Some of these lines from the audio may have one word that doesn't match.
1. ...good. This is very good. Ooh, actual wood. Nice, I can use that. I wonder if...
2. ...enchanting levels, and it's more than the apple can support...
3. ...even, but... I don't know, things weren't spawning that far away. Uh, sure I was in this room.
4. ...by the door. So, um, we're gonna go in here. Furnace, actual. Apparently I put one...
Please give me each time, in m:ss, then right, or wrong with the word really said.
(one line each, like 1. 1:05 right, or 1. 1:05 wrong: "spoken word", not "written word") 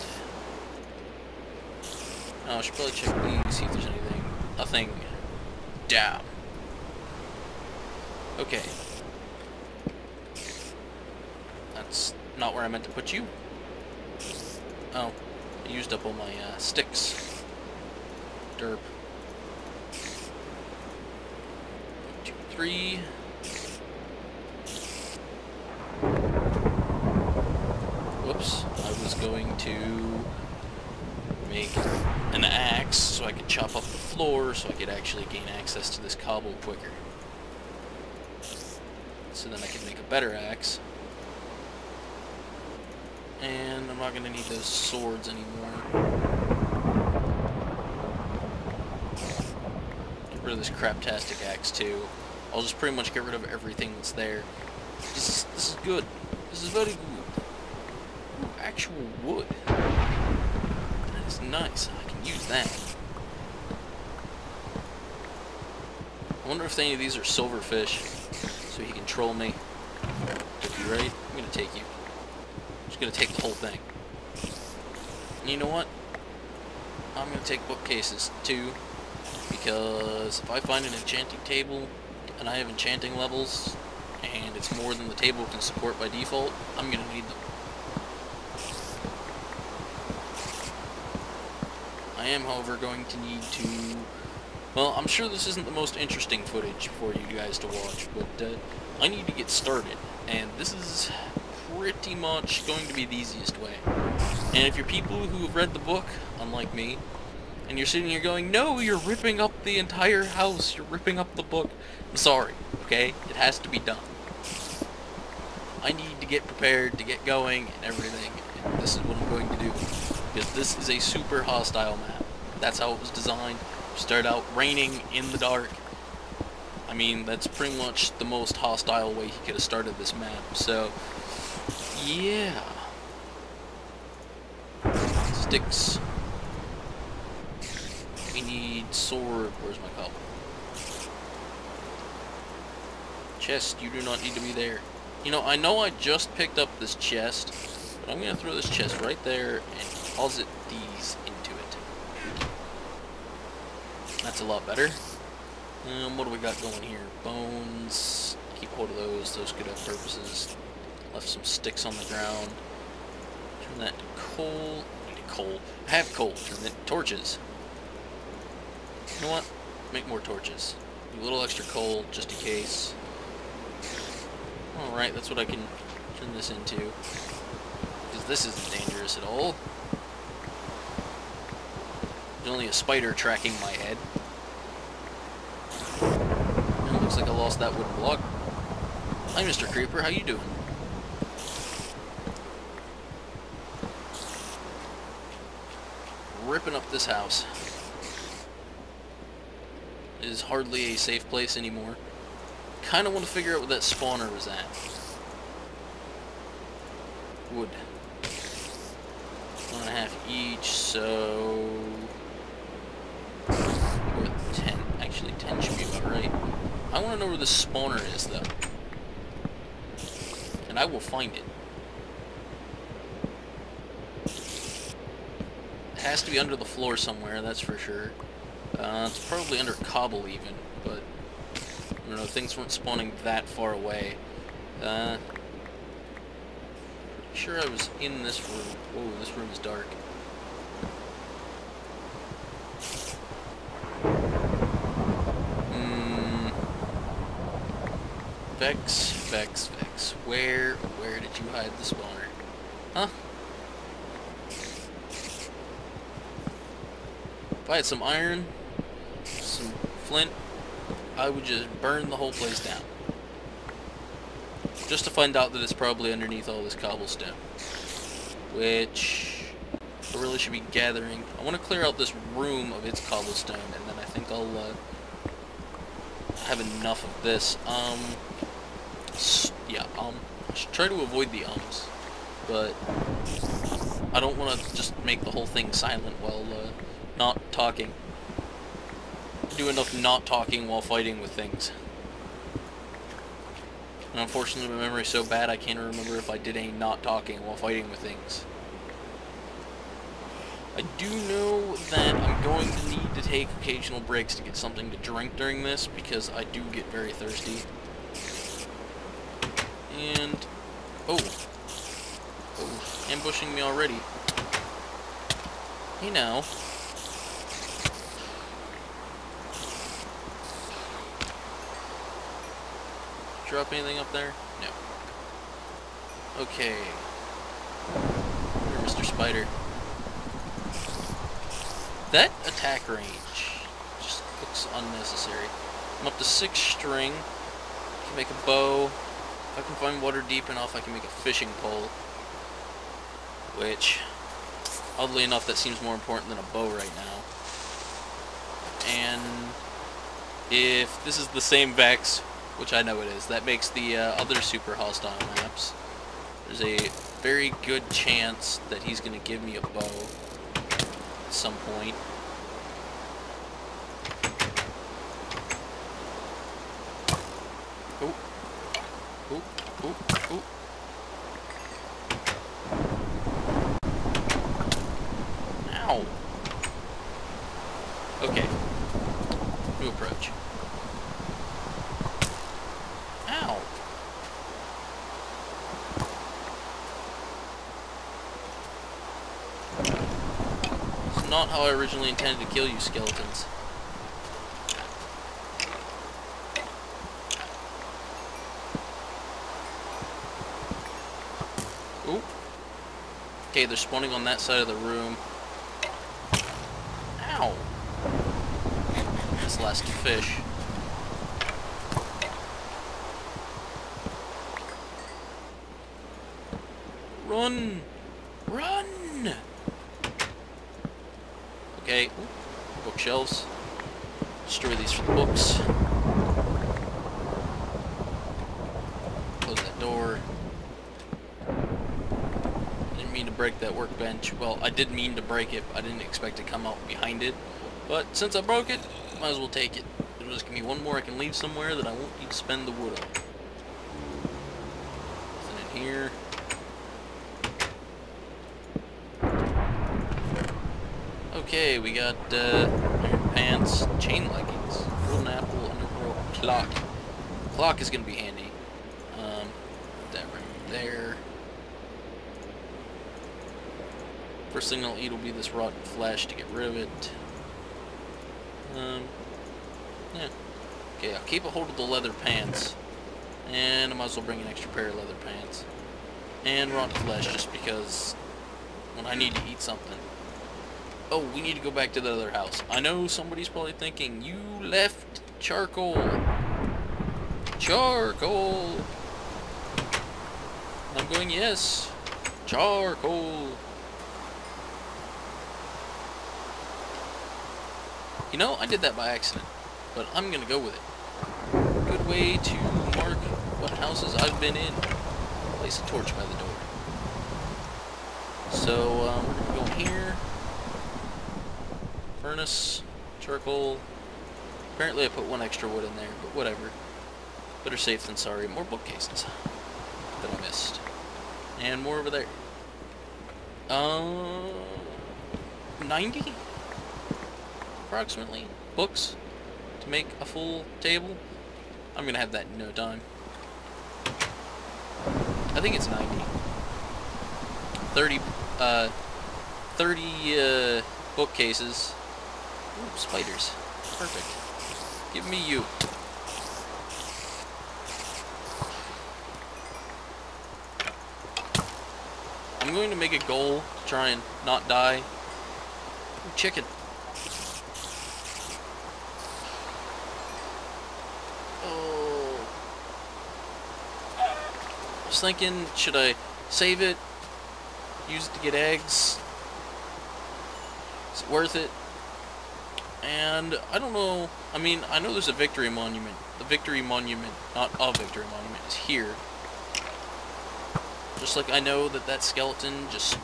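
1. 0:55 right
2. 1:22 wrong: "table", not "apple"
3. 3:50 right
4. 8:26 wrong: "charcoal", not "actual".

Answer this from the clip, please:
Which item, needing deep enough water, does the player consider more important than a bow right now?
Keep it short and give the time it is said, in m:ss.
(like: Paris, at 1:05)
fishing pole, at 5:41.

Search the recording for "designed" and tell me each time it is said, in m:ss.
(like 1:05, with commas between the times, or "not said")
2:03.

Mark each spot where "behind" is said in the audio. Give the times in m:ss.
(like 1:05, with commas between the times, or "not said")
7:16.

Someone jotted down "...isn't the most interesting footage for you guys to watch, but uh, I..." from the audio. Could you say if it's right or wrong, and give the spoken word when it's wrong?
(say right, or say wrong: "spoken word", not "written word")
right.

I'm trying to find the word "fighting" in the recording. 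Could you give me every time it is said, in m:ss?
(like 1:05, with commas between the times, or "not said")
4:50, 4:57.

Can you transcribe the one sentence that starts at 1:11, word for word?
I'm just gonna take the whole thing.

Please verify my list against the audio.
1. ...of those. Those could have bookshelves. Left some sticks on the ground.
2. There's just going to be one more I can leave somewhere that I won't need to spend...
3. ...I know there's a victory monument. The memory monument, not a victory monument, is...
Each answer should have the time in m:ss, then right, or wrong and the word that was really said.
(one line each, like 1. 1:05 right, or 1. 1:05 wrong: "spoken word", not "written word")
1. 2:38 wrong: "purposes", not "bookshelves"
2. 7:20 right
3. 9:34 wrong: "victory", not "memory".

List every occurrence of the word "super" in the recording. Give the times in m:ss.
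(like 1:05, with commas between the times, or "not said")
2:00, 5:54.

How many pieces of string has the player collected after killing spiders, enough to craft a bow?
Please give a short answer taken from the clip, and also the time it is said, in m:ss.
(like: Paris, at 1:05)
6, at 5:36.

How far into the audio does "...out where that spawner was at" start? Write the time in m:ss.
3:23.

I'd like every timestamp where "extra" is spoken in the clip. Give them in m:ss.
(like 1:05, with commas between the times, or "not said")
2:51, 7:54, 8:35.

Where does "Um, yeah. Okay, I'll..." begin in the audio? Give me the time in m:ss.
7:48.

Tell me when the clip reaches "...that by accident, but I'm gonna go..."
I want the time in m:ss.
8:18.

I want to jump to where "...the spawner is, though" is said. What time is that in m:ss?
3:37.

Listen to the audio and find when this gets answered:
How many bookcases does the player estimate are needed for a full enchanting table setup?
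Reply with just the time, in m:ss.
8:59.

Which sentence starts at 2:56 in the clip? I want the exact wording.
Because this isn't dangerous at all.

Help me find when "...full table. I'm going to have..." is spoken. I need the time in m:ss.
8:50.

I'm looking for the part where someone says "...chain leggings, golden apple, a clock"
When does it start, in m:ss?
7:33.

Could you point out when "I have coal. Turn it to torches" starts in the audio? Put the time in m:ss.
2:45.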